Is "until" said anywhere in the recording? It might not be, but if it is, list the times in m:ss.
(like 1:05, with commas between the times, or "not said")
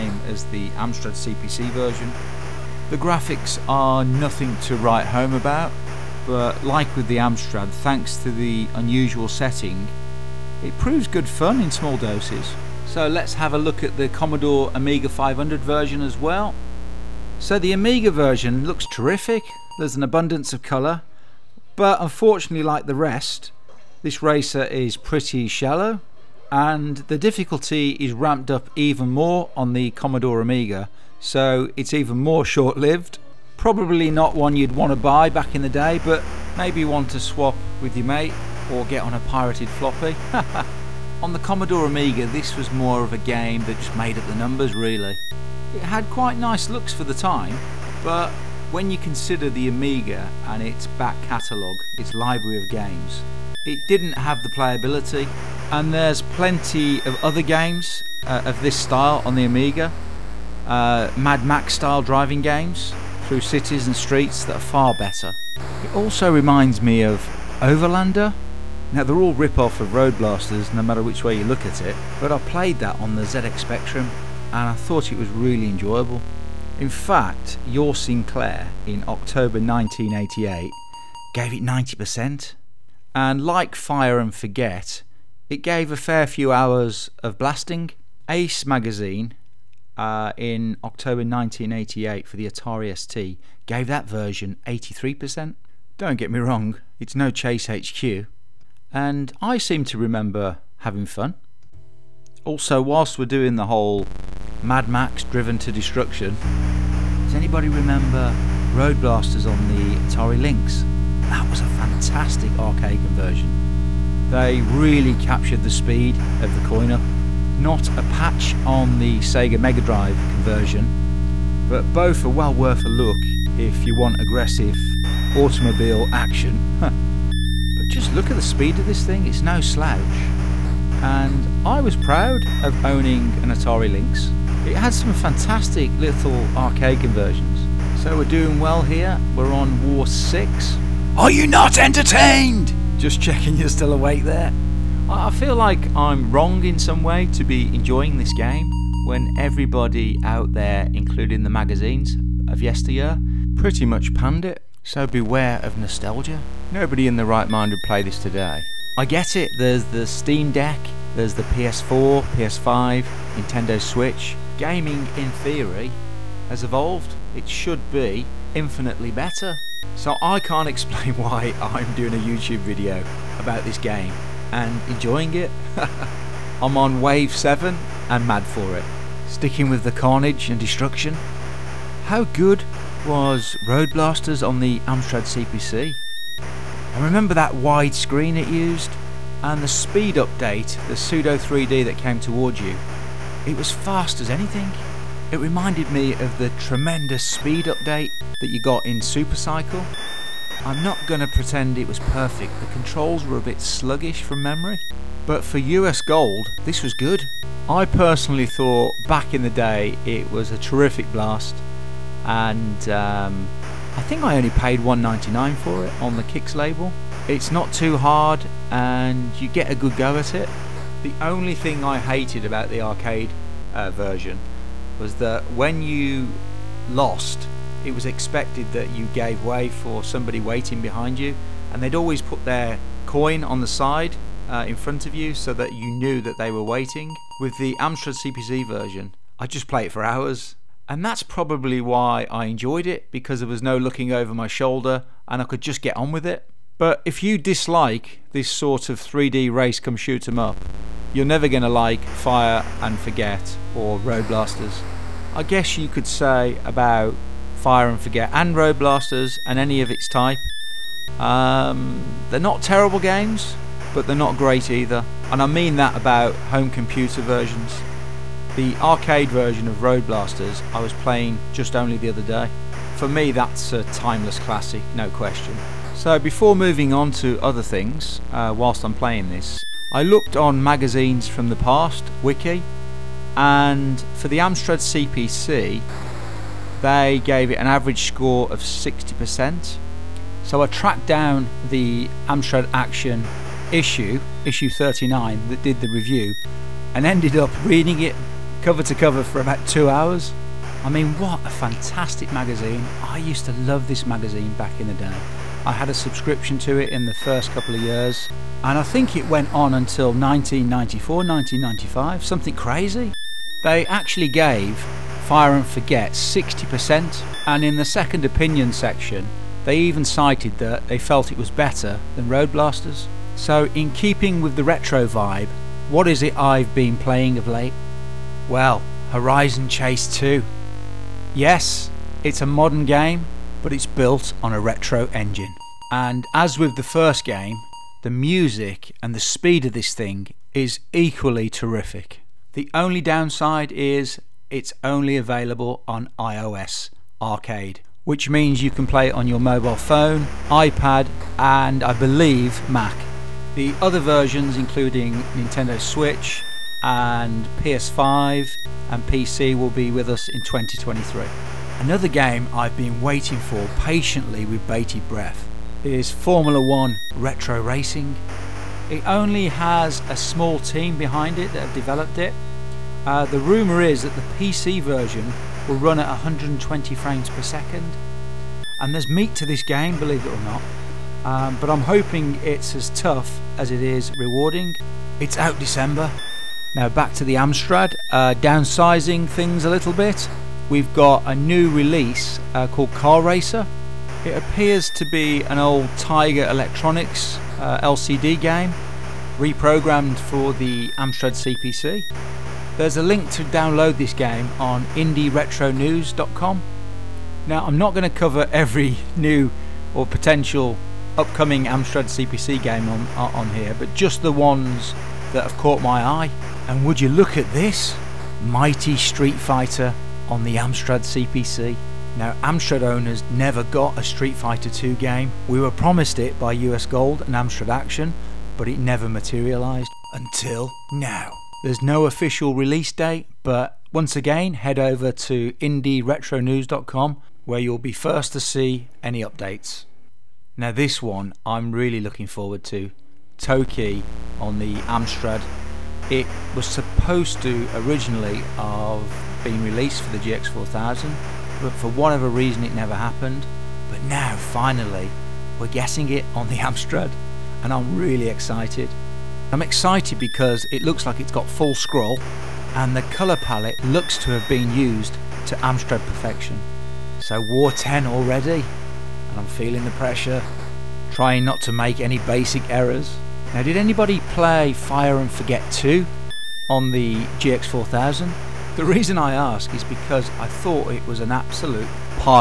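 5:09, 7:10.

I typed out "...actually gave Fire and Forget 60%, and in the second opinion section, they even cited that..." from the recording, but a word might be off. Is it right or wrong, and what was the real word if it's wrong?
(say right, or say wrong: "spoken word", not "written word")
right.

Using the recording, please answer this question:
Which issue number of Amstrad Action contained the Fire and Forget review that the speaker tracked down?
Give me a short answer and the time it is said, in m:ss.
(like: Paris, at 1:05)
39, at 4:54.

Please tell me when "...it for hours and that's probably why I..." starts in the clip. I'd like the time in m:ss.
3:59.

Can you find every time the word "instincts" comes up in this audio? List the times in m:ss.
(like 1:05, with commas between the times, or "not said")
not said.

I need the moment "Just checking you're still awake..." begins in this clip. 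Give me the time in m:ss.
2:22.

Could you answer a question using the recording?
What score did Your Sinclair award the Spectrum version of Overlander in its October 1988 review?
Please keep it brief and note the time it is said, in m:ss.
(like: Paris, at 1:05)
90%, at 1:21.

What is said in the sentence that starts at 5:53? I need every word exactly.
The other versions, including Nintendo Switch, and PS5 and PC will be with us in 2023.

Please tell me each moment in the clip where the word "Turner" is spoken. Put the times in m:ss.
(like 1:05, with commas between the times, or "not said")
not said.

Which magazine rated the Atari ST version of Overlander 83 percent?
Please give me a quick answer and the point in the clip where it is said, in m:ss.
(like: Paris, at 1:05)
Ace, at 1:28.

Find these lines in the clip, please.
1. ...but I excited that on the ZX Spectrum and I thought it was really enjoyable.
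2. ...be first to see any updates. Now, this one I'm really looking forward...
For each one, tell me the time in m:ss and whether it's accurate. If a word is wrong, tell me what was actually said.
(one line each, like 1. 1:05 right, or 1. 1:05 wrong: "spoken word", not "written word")
1. 1:12 wrong: "played", not "excited"
2. 7:17 right.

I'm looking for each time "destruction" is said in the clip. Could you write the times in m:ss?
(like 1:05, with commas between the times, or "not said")
1:45, 3:00.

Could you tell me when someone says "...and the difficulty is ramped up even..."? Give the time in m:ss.
0:26.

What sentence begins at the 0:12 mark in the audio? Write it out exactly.
So let's have a look at the Commodore Amiga 500 version as well.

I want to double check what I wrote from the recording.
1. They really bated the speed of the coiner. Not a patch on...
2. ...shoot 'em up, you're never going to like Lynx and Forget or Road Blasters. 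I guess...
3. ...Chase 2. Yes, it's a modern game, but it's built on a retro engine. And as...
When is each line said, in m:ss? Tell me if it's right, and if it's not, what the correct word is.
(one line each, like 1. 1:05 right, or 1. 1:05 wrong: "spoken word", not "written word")
1. 1:54 wrong: "captured", not "bated"
2. 4:09 wrong: "Fire", not "Lynx"
3. 5:29 right.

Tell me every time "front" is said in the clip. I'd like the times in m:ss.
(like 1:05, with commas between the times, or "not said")
3:54.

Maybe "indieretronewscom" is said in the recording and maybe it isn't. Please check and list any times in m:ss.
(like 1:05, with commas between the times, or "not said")
6:44, 7:15.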